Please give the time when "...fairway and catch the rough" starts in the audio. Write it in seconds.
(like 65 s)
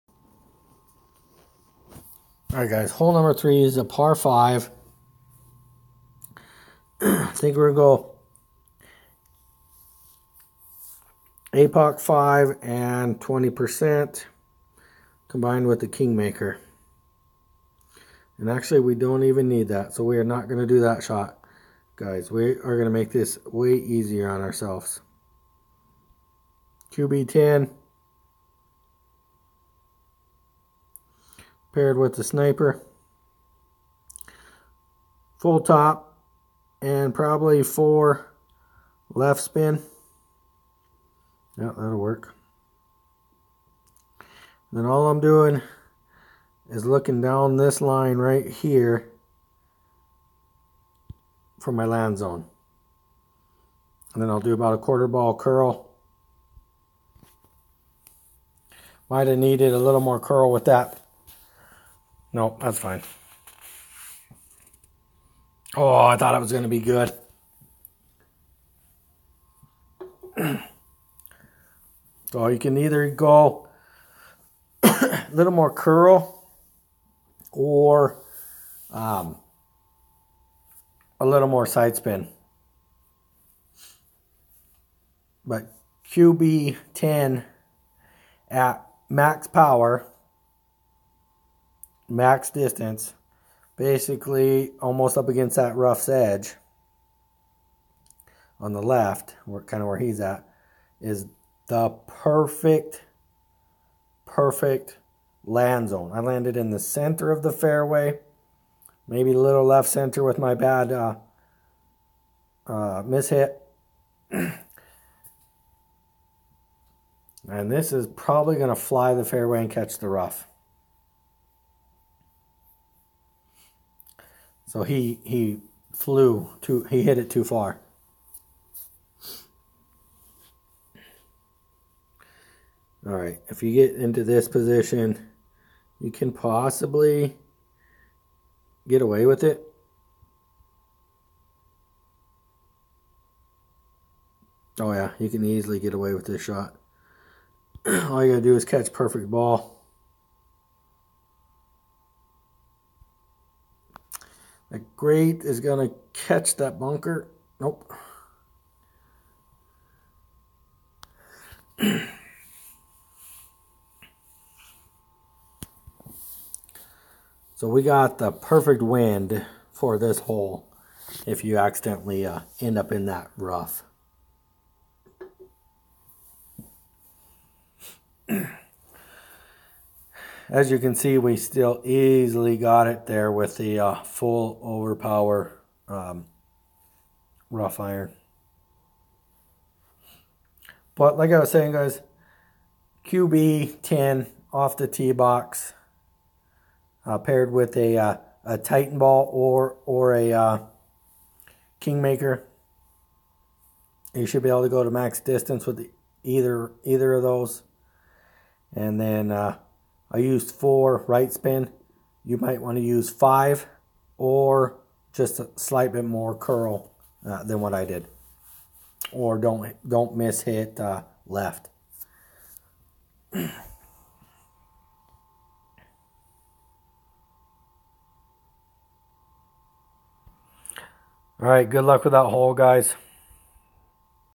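119 s.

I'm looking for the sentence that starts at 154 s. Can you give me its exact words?
The great is going to catch that bunker.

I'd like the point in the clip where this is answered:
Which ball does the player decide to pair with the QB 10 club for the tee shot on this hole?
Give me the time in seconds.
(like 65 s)
32 s.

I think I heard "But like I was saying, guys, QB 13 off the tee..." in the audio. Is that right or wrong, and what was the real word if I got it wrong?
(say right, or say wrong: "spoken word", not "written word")
wrong: "10", not "13".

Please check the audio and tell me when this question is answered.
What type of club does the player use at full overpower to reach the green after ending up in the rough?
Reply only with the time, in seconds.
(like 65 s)
187 s.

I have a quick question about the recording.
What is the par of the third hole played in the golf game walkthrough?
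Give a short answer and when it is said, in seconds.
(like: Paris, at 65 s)
5, at 3 s.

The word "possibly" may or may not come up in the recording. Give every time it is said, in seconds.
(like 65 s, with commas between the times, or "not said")
136 s.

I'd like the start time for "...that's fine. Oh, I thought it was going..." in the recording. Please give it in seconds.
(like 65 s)
62 s.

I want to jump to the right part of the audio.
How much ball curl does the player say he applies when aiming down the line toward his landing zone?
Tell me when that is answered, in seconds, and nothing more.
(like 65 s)
54 s.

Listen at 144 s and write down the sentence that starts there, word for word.
Oh yeah, you can easily get away with this shot.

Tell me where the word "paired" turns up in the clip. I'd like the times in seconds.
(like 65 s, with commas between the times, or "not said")
31 s, 197 s.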